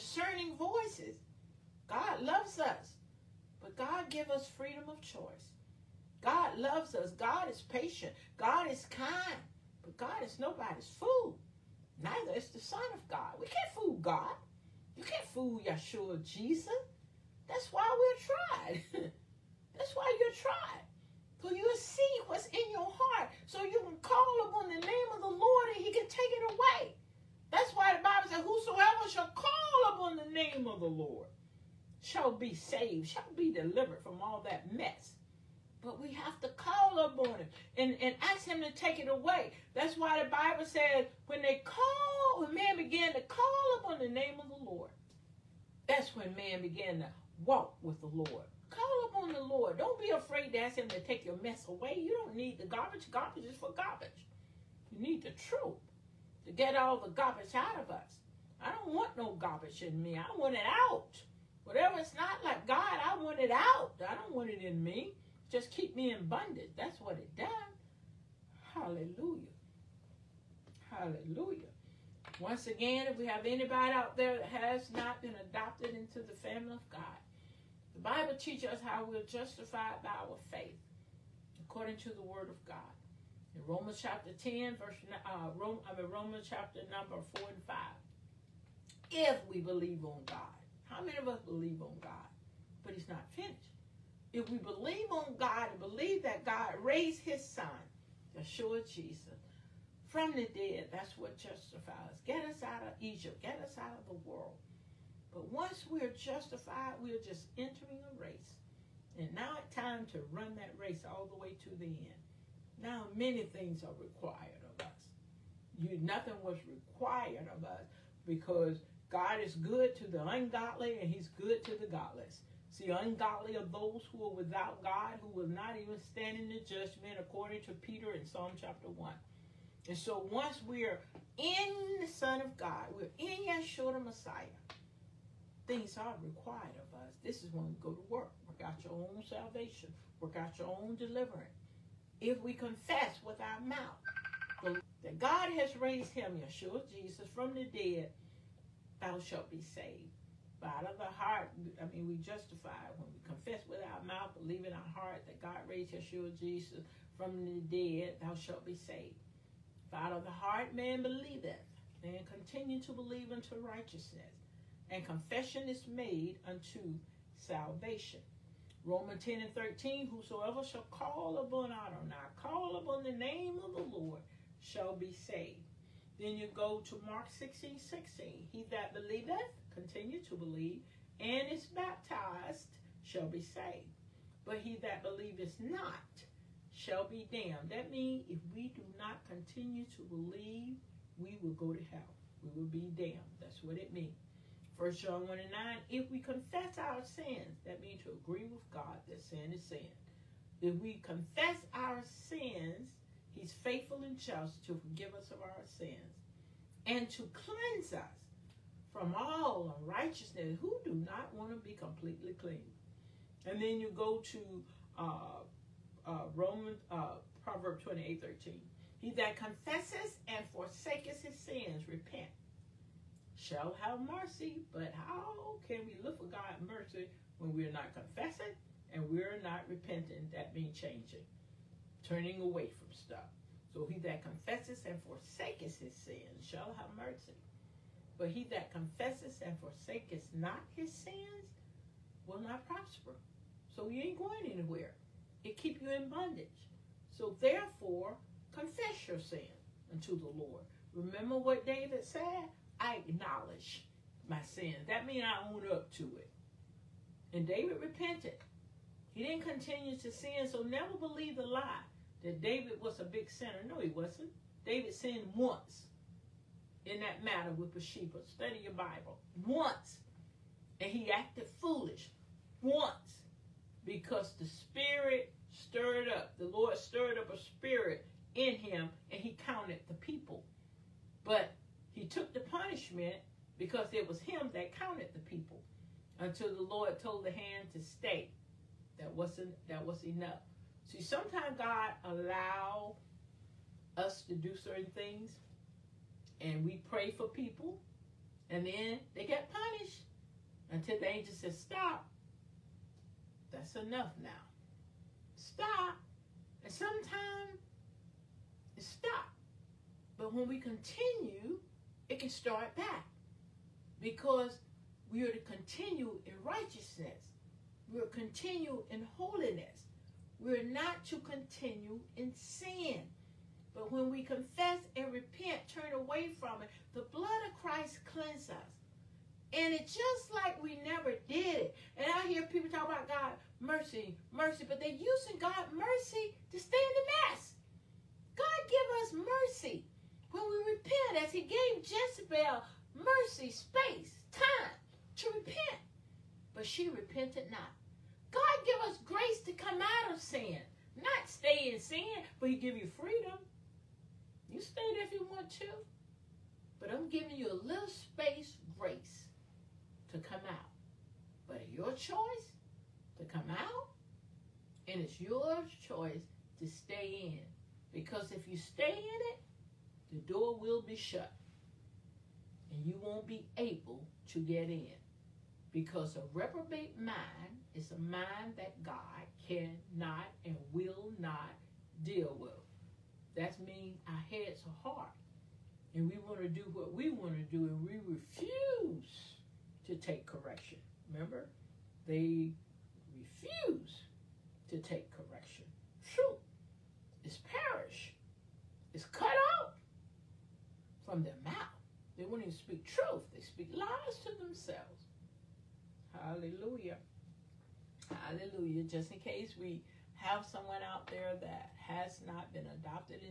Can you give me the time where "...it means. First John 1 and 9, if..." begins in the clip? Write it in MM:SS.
03:13.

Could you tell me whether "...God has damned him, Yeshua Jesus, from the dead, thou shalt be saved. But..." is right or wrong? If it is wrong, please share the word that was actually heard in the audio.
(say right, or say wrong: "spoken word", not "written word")
wrong: "raised", not "damned".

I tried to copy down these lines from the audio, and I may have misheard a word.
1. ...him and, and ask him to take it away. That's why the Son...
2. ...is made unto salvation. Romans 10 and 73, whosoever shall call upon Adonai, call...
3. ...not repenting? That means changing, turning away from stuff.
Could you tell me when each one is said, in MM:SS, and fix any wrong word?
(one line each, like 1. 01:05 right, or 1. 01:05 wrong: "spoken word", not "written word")
1. 00:37 wrong: "Bible", not "Son"
2. 02:45 wrong: "13", not "73"
3. 03:49 right.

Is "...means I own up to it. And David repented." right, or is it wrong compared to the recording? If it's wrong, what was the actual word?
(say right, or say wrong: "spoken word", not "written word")
right.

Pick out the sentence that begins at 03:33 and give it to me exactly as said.
And then you go to uh, uh, Romans, uh, Proverbs 28, 13.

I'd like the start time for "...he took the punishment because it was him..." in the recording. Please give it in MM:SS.
04:41.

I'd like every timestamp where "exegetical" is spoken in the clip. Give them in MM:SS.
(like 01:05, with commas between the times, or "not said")
not said.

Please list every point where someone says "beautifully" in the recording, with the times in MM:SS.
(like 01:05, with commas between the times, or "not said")
not said.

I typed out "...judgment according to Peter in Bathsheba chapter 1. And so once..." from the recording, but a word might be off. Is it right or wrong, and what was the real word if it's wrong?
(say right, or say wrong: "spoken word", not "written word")
wrong: "Psalm", not "Bathsheba".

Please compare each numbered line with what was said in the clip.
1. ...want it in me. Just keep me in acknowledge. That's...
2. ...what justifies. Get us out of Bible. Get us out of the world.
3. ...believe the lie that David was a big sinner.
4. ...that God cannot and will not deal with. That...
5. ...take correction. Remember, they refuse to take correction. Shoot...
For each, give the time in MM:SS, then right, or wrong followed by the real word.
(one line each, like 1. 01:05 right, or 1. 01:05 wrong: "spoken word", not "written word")
1. 01:04 wrong: "bondage", not "acknowledge"
2. 01:41 wrong: "Egypt", not "Bible"
3. 04:20 right
4. 06:18 right
5. 06:29 right.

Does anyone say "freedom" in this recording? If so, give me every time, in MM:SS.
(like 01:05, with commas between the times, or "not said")
00:04, 05:52.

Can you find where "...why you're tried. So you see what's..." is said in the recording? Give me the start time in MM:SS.
00:19.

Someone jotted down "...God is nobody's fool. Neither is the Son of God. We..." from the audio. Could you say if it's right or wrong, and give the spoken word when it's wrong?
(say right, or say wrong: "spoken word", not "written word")
right.